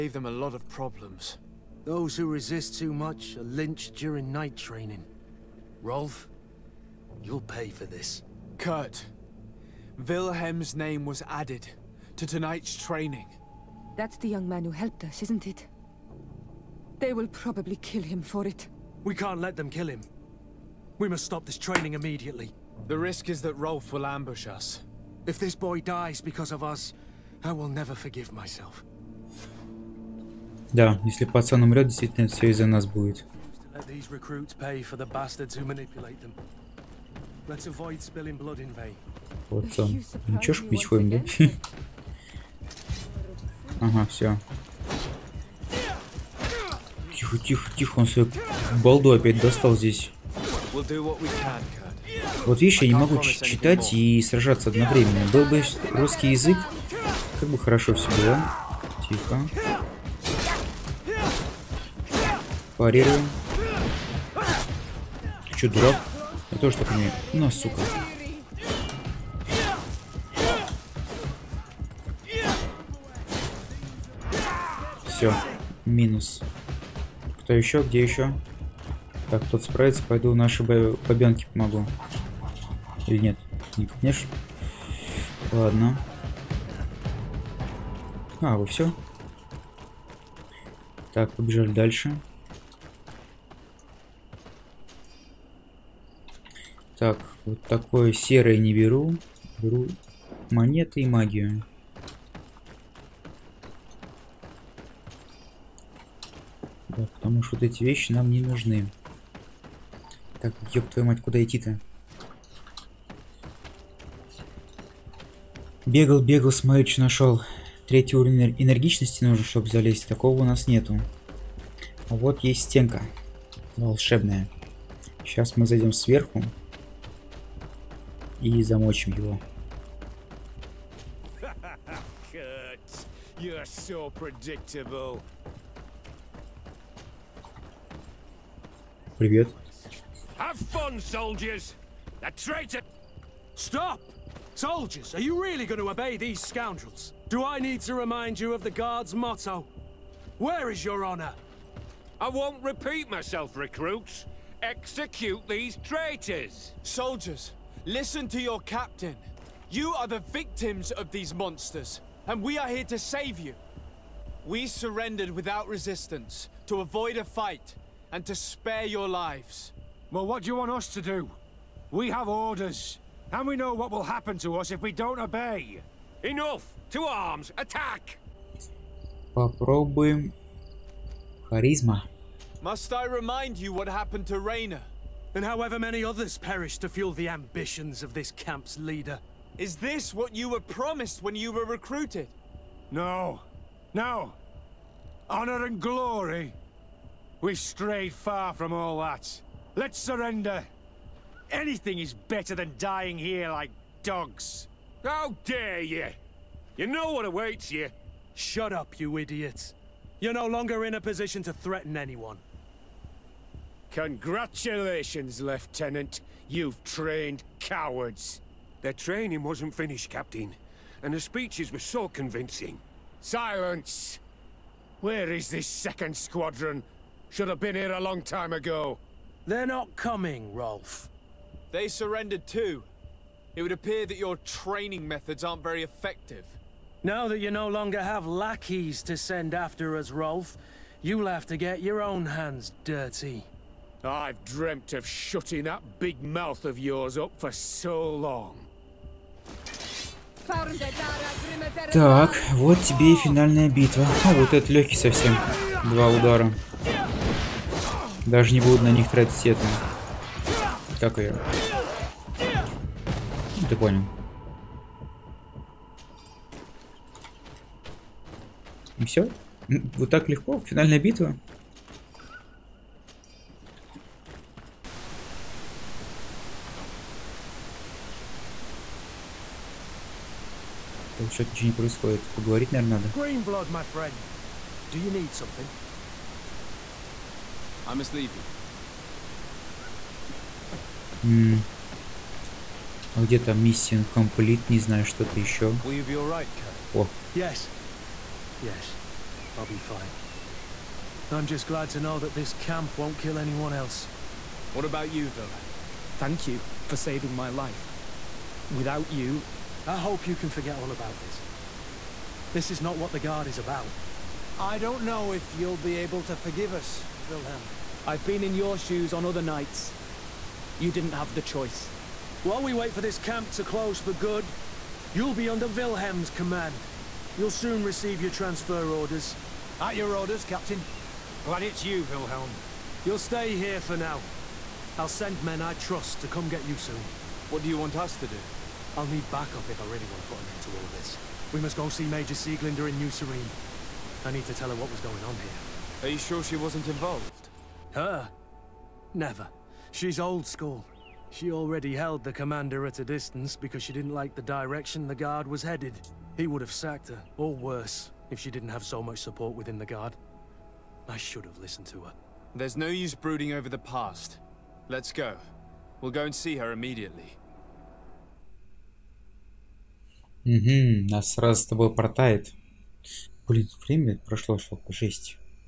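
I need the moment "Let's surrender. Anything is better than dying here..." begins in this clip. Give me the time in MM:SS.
03:19.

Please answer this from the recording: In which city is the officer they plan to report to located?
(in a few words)
New Serene.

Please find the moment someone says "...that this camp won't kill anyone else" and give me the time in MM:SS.
05:02.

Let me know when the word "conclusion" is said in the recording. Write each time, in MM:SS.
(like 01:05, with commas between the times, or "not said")
not said.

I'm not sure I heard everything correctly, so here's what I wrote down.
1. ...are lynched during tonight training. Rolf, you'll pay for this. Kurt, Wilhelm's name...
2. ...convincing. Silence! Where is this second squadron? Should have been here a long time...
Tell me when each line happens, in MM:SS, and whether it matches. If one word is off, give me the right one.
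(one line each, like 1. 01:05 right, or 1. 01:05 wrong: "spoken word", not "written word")
1. 00:03 wrong: "night", not "tonight"
2. 03:42 right.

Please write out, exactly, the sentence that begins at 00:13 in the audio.
That's the young man who helped us, isn't it?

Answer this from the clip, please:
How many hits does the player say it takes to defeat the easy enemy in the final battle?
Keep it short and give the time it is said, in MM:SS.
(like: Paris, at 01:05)
2, at 04:15.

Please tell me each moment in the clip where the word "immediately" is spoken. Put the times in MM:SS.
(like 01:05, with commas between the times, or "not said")
00:21, 06:06.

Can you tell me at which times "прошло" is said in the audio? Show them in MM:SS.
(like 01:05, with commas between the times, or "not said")
06:14.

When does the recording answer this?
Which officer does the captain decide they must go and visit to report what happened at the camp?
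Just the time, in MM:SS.
05:42.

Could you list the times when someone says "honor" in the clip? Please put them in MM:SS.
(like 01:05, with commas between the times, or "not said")
02:31, 03:15.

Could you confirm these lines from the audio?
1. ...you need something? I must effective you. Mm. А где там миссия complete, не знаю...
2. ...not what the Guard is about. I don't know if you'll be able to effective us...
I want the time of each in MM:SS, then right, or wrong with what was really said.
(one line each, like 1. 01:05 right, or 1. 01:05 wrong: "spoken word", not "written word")
1. 04:44 wrong: "leave", not "effective"
2. 05:12 wrong: "forgive", not "effective".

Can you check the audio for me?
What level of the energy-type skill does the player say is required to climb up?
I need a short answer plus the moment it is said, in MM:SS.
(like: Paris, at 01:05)
3, at 01:57.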